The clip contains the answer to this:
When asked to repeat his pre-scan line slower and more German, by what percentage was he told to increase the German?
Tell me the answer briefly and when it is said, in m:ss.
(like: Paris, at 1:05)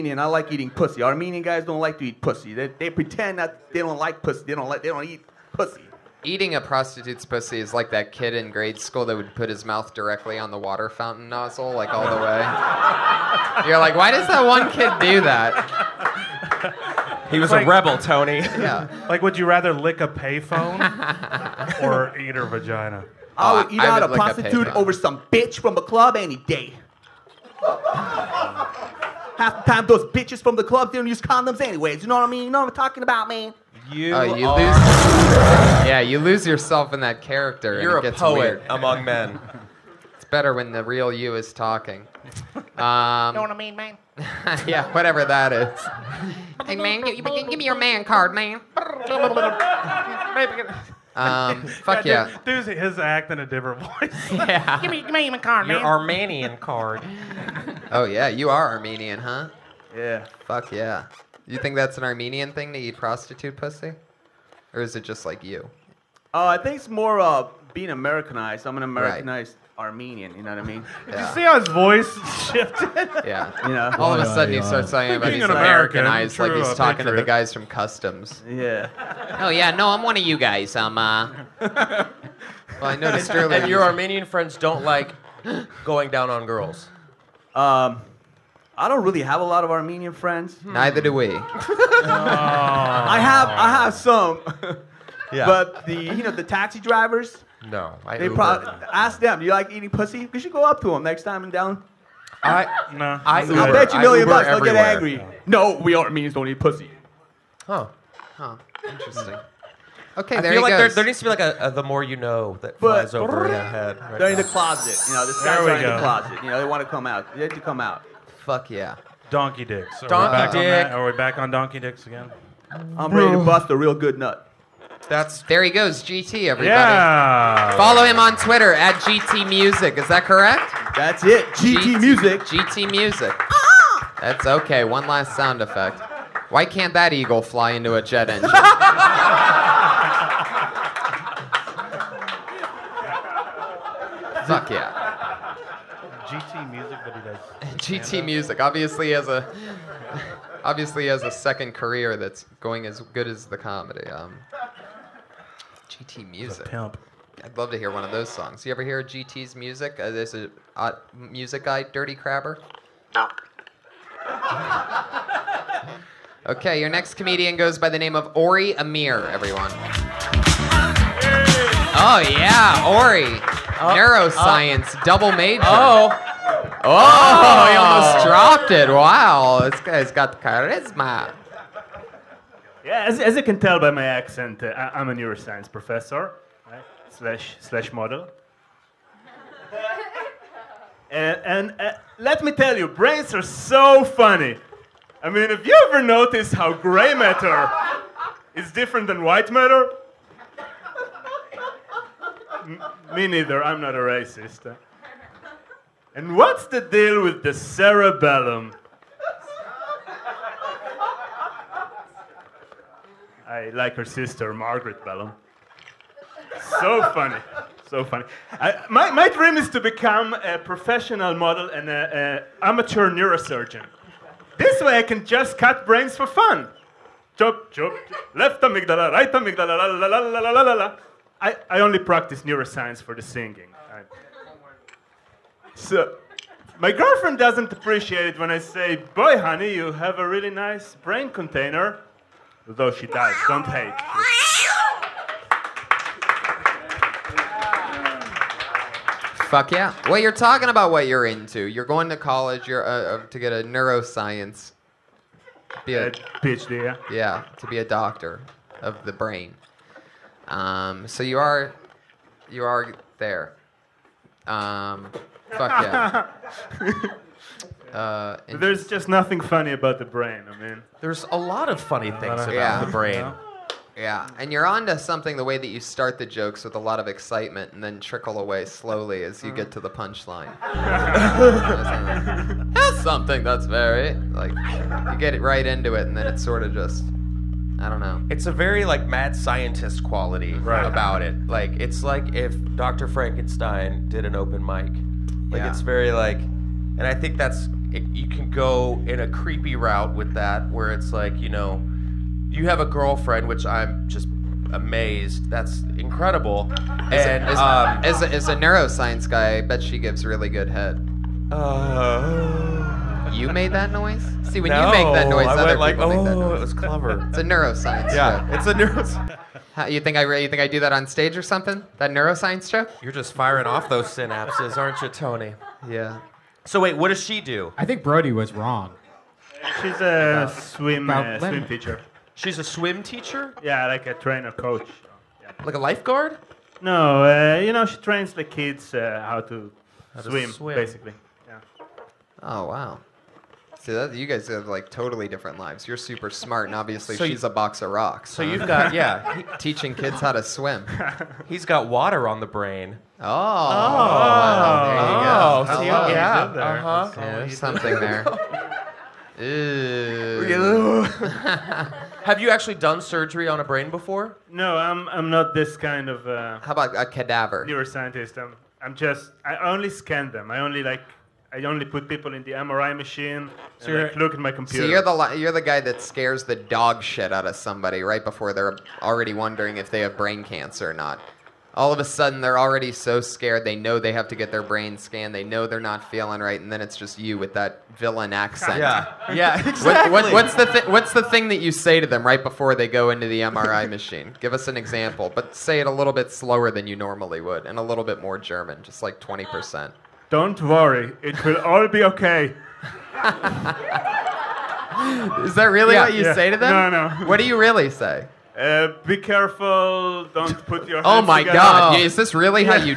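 20 percent, at 6:39.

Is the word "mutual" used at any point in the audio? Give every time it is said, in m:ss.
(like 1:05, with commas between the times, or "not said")
not said.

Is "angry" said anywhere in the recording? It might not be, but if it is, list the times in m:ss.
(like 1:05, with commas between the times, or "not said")
1:44.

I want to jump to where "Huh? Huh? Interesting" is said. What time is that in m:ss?
1:47.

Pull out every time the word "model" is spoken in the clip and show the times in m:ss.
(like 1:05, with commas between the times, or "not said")
3:07, 3:41.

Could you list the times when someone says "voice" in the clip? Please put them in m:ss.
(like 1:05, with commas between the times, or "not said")
0:53, 1:11.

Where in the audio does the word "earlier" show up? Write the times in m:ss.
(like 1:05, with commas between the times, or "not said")
1:23.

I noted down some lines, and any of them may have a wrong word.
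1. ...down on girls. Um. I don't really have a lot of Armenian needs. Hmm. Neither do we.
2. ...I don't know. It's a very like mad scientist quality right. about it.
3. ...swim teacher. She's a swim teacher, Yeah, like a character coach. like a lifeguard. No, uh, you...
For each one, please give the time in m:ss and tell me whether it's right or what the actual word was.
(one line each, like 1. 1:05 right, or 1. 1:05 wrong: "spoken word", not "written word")
1. 1:26 wrong: "friends", not "needs"
2. 4:47 right
3. 5:31 wrong: "trainer", not "character".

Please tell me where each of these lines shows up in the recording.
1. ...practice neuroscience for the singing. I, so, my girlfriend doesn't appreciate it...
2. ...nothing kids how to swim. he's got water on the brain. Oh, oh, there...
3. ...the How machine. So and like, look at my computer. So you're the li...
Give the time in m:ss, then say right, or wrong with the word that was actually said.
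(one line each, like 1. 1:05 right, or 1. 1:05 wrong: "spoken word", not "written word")
1. 3:51 right
2. 5:49 wrong: "teaching", not "nothing"
3. 6:12 wrong: "MRI", not "How".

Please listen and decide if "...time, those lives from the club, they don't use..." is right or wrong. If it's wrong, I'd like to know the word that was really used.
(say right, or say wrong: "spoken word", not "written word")
wrong: "bitches", not "lives".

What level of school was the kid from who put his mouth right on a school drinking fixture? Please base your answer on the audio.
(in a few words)
grade school.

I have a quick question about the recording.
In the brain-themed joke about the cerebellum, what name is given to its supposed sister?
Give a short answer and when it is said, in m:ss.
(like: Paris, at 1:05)
Margaret Bellum, at 3:34.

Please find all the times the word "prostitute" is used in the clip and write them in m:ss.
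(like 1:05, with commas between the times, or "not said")
0:06, 0:24, 1:02.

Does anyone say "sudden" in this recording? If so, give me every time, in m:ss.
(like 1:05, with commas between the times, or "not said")
1:14, 6:22.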